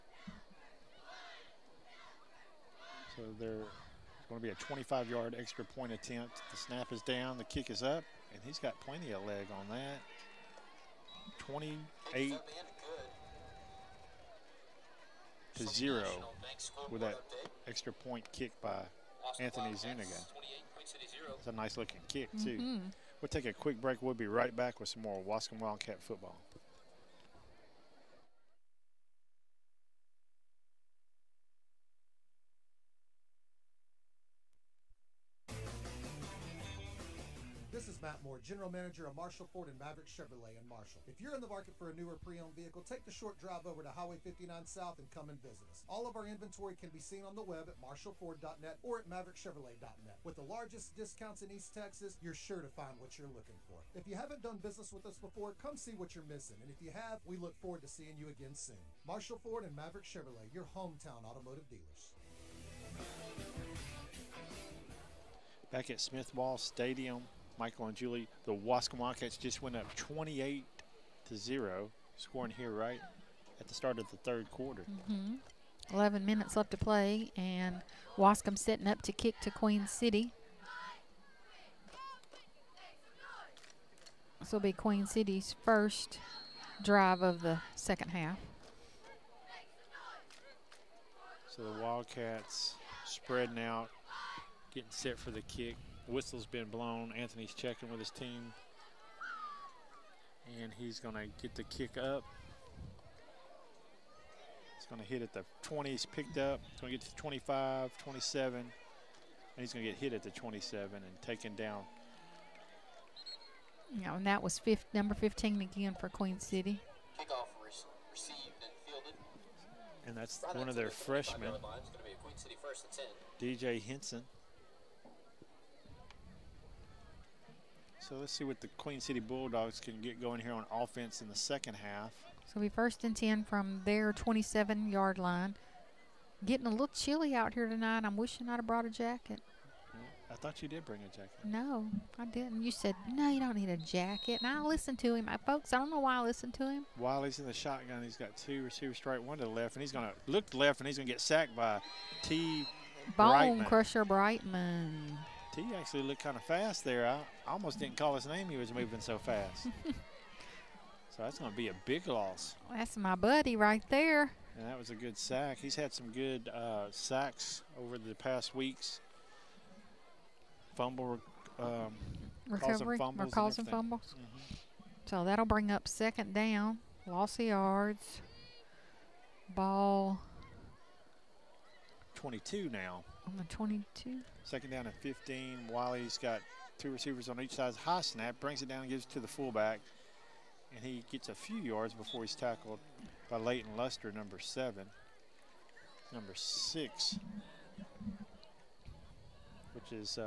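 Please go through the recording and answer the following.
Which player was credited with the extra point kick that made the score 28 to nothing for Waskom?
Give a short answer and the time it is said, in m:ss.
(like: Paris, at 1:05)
Anthony Zuniga, at 0:19.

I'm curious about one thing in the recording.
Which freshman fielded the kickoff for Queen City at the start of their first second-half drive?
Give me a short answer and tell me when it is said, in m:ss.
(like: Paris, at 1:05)
DJ Henson, at 2:03.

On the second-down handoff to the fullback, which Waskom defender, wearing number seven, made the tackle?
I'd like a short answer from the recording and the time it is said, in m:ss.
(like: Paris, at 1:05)
Leighton Luster, at 3:13.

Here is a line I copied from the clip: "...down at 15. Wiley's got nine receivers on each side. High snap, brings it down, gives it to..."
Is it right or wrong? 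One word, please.
wrong.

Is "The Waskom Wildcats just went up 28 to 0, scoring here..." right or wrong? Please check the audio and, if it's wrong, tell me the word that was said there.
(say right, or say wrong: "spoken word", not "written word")
right.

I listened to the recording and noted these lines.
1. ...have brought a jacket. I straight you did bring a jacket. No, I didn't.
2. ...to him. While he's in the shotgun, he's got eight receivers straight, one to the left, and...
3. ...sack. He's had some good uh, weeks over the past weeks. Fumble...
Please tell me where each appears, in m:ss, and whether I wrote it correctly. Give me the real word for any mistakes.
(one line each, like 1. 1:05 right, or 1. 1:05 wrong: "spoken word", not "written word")
1. 2:18 wrong: "thought", not "straight"
2. 2:26 wrong: "two", not "eight"
3. 2:45 wrong: "sacks", not "weeks".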